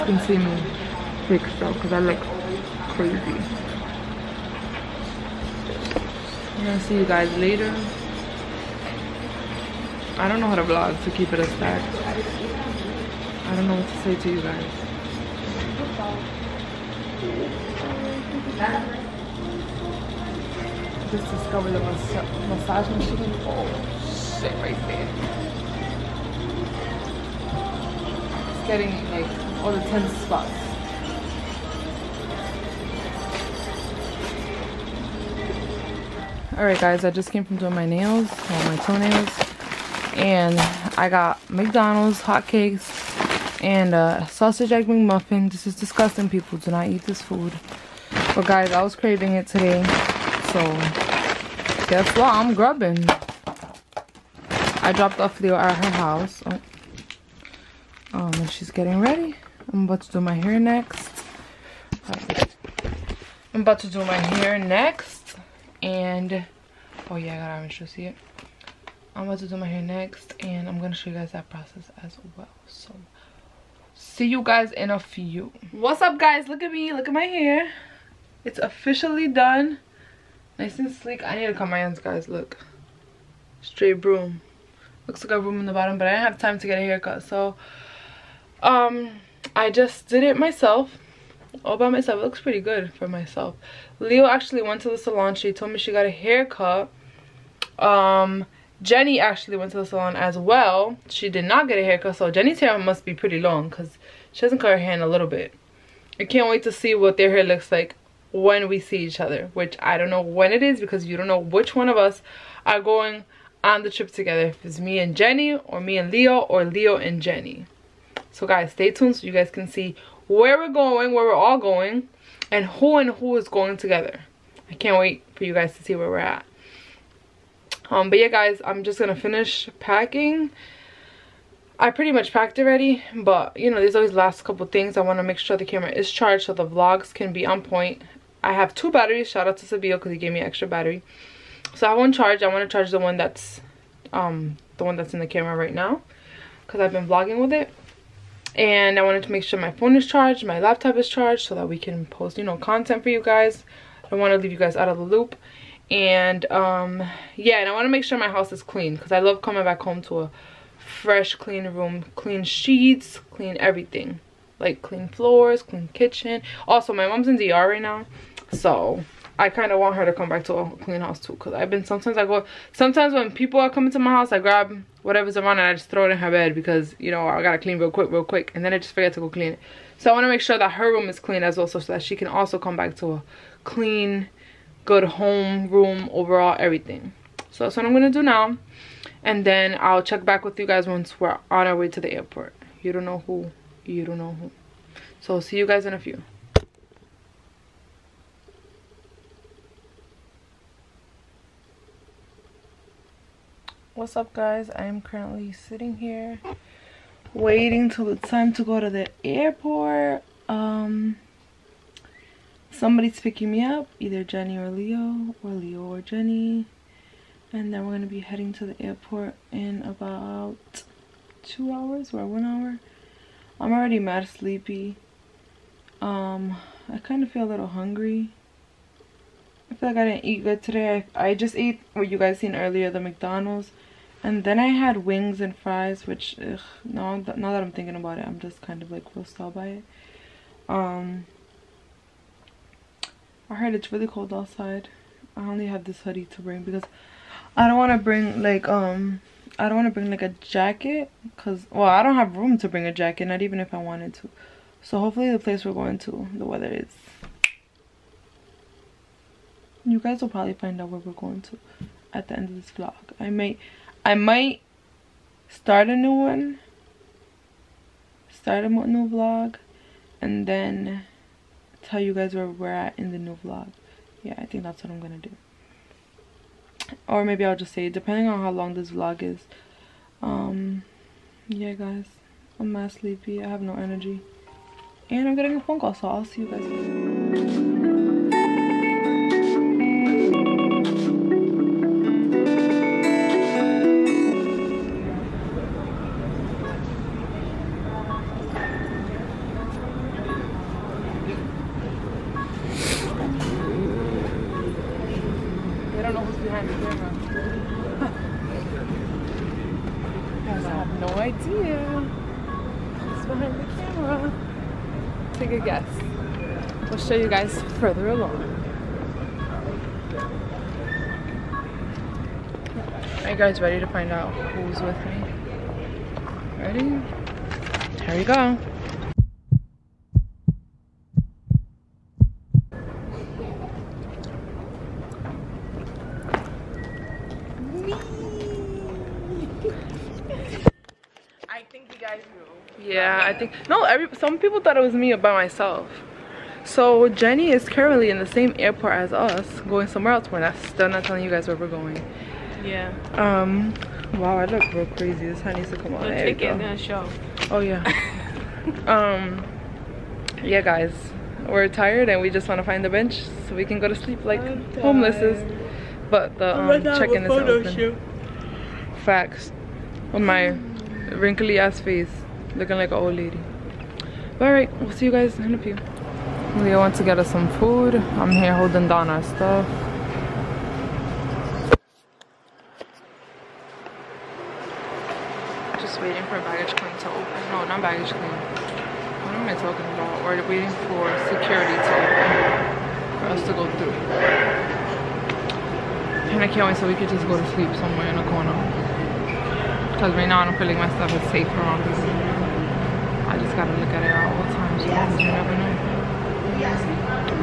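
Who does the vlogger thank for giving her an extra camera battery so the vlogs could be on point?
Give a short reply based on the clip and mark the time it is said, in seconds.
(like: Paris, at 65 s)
Sabio, at 139 s.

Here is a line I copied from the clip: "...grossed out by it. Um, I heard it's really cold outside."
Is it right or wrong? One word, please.
right.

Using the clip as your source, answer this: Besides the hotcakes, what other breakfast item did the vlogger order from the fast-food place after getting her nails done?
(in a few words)
Sausage egg McMuffin.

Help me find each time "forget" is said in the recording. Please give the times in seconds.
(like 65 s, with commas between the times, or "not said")
178 s.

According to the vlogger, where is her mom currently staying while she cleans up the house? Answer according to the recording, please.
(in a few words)
DR.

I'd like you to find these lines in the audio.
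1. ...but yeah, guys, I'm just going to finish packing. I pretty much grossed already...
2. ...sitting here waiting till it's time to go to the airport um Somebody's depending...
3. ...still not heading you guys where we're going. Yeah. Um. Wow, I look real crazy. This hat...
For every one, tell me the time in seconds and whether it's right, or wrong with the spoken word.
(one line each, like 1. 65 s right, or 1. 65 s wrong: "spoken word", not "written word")
1. 128 s wrong: "packed", not "grossed"
2. 205 s wrong: "picking", not "depending"
3. 350 s wrong: "telling", not "heading".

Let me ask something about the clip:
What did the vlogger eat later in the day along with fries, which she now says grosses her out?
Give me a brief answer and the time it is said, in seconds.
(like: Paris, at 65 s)
Wings, at 235 s.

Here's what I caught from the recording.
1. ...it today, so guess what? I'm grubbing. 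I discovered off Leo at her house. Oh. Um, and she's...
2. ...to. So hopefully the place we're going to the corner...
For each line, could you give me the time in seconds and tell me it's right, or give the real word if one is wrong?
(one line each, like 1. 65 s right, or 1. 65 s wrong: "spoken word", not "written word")
1. 49 s wrong: "dropped", not "discovered"
2. 254 s wrong: "weather", not "corner".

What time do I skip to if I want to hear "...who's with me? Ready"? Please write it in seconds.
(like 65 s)
324 s.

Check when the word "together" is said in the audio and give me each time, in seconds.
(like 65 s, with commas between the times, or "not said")
114 s, 123 s.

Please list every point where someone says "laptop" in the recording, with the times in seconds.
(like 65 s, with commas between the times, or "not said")
150 s.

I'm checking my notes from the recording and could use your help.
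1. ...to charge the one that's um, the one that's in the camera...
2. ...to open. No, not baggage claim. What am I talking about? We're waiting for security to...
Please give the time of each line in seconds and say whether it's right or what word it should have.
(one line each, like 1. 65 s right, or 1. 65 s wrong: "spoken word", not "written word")
1. 142 s right
2. 386 s right.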